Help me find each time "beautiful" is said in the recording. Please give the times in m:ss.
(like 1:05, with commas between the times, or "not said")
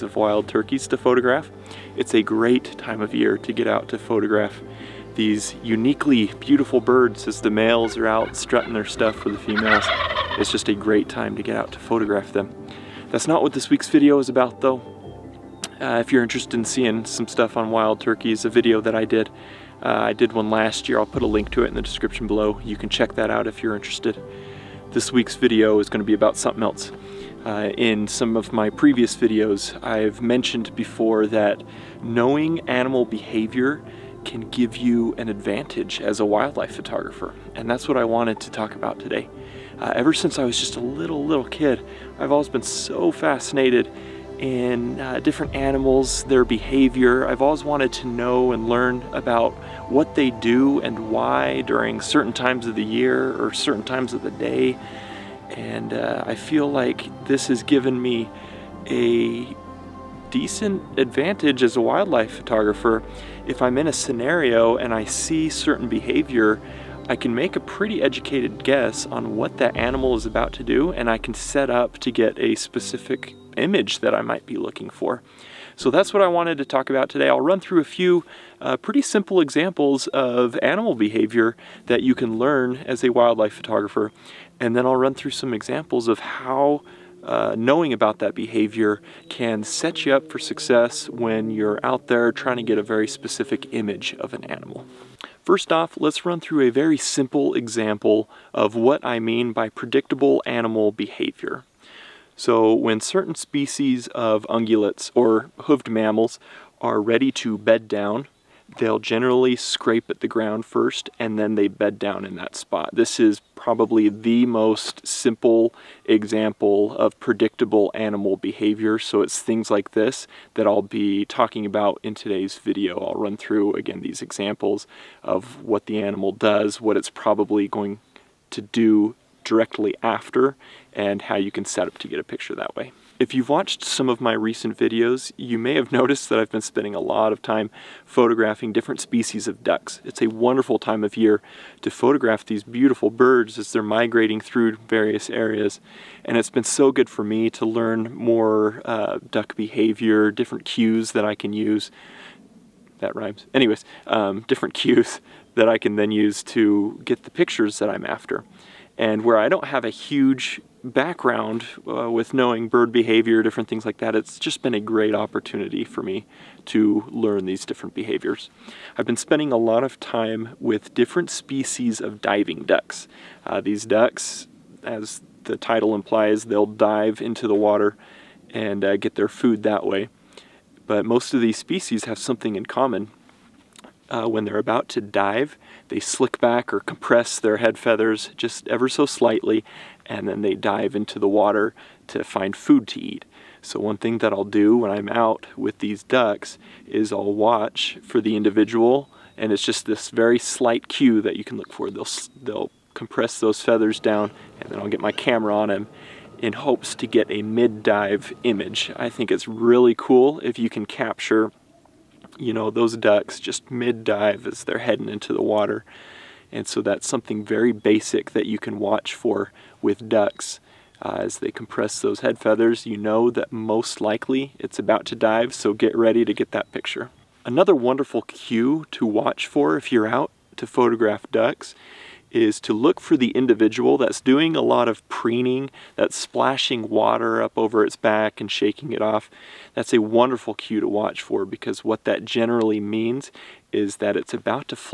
0:06, 2:22.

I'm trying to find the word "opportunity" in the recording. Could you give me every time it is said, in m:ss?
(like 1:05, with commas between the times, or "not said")
2:45.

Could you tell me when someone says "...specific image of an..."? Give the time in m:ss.
1:33.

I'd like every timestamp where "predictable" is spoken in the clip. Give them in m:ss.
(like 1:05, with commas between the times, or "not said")
1:39, 1:57.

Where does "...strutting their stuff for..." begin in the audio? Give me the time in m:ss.
0:08.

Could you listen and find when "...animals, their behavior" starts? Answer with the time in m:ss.
0:45.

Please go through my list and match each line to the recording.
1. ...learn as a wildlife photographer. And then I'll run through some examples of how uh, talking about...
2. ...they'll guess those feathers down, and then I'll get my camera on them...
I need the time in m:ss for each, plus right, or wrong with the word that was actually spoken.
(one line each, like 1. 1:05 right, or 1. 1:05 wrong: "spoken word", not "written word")
1. 1:22 wrong: "knowing", not "talking"
2. 3:22 wrong: "compress", not "guess".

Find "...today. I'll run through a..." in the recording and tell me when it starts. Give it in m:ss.
1:17.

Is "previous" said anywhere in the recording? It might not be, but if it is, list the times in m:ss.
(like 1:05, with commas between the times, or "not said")
0:28.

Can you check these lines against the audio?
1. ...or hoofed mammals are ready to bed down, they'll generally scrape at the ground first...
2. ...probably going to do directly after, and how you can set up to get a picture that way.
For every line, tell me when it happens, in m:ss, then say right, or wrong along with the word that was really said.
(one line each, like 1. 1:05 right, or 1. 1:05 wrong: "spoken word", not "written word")
1. 1:45 right
2. 2:07 right.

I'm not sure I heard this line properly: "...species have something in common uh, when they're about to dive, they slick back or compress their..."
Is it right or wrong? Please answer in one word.
right.